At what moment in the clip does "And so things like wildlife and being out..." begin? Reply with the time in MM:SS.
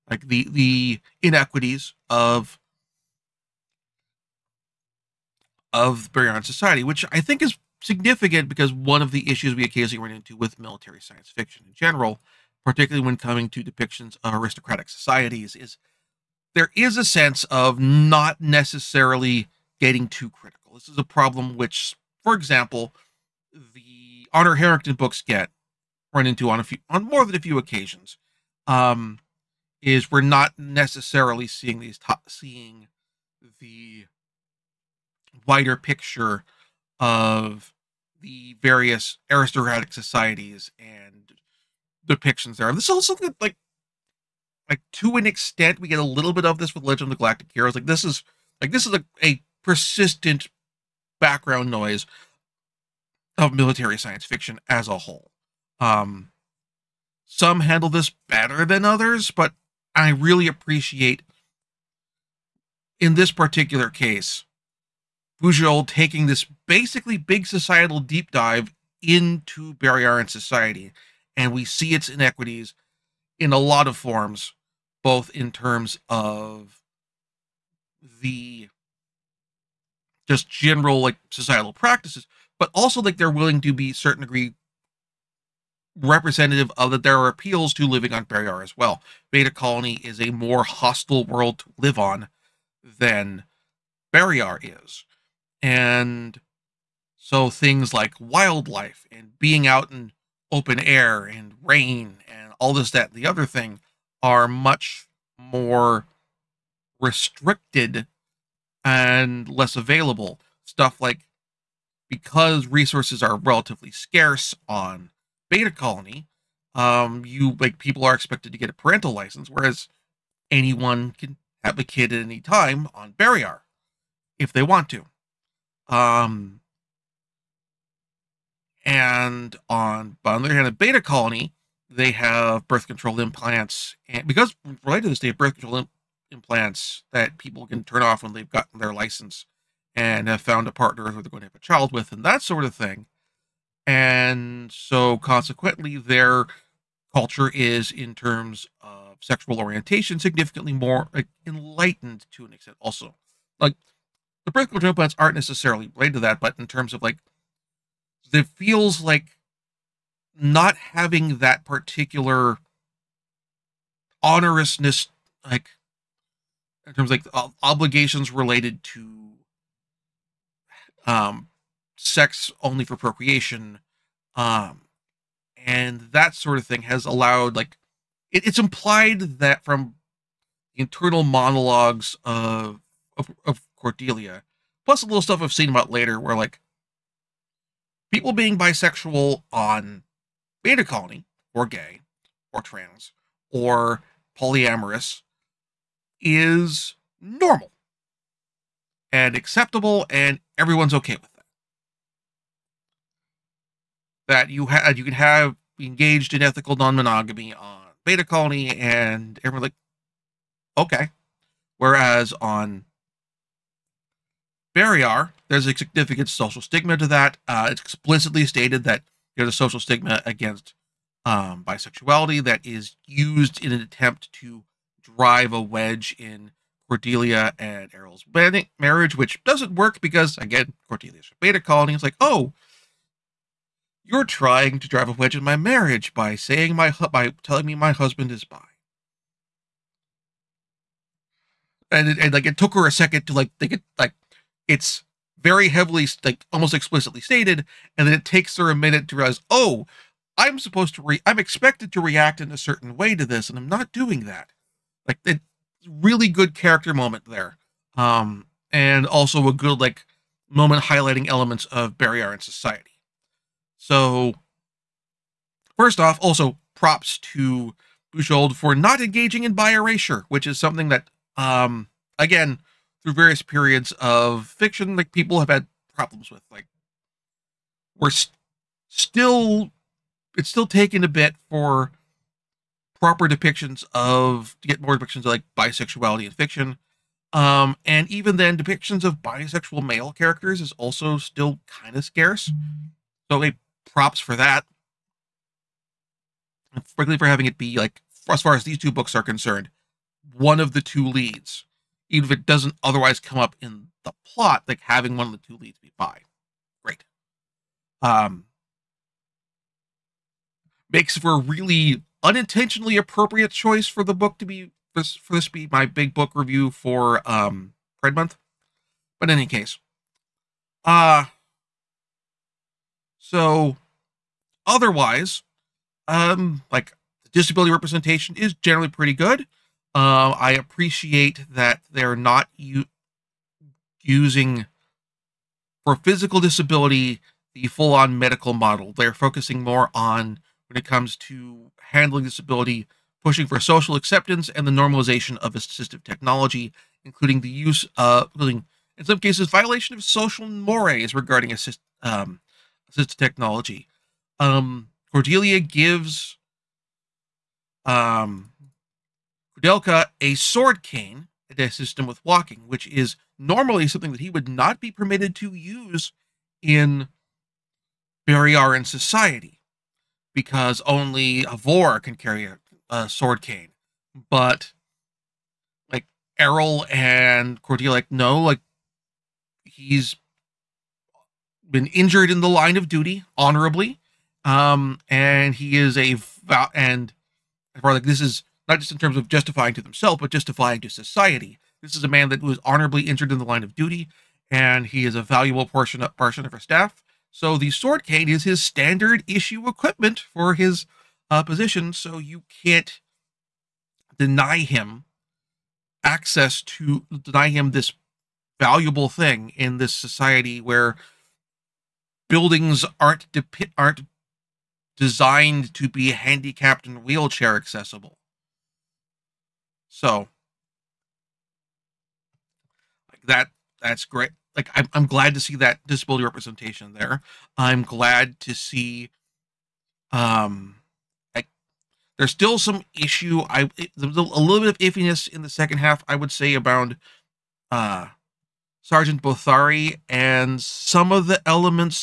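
01:35.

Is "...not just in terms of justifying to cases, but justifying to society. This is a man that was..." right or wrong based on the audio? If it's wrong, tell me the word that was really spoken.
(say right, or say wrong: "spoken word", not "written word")
wrong: "themselves", not "cases".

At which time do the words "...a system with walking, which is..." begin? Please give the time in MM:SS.
06:01.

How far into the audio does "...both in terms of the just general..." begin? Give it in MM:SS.
01:15.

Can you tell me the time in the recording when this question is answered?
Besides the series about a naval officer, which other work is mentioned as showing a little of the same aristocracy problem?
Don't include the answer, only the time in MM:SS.
00:46.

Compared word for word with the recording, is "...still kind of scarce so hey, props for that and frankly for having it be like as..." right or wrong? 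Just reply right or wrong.
right.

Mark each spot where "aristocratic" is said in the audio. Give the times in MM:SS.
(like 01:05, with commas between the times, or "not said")
00:14, 00:39.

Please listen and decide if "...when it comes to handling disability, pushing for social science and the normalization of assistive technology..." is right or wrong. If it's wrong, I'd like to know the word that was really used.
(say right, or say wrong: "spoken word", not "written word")
wrong: "acceptance", not "science".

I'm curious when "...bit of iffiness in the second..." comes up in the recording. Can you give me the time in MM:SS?
07:14.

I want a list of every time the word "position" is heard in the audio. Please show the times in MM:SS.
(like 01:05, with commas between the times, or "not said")
06:41.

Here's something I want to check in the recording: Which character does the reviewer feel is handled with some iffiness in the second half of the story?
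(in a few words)
Sergeant Bothari.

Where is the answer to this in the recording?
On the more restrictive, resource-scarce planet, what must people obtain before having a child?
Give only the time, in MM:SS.
01:58.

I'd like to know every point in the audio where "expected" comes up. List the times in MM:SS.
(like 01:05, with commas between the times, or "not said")
01:58, 04:11.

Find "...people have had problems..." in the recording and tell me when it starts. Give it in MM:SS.
04:35.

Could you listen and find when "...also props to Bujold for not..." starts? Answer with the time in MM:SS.
04:26.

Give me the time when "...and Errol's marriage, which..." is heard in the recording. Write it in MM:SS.
03:47.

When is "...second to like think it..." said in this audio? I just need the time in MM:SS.
04:02.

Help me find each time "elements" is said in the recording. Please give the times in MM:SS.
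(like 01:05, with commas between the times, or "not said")
04:21, 07:21.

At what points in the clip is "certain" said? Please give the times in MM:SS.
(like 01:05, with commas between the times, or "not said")
01:23, 04:12.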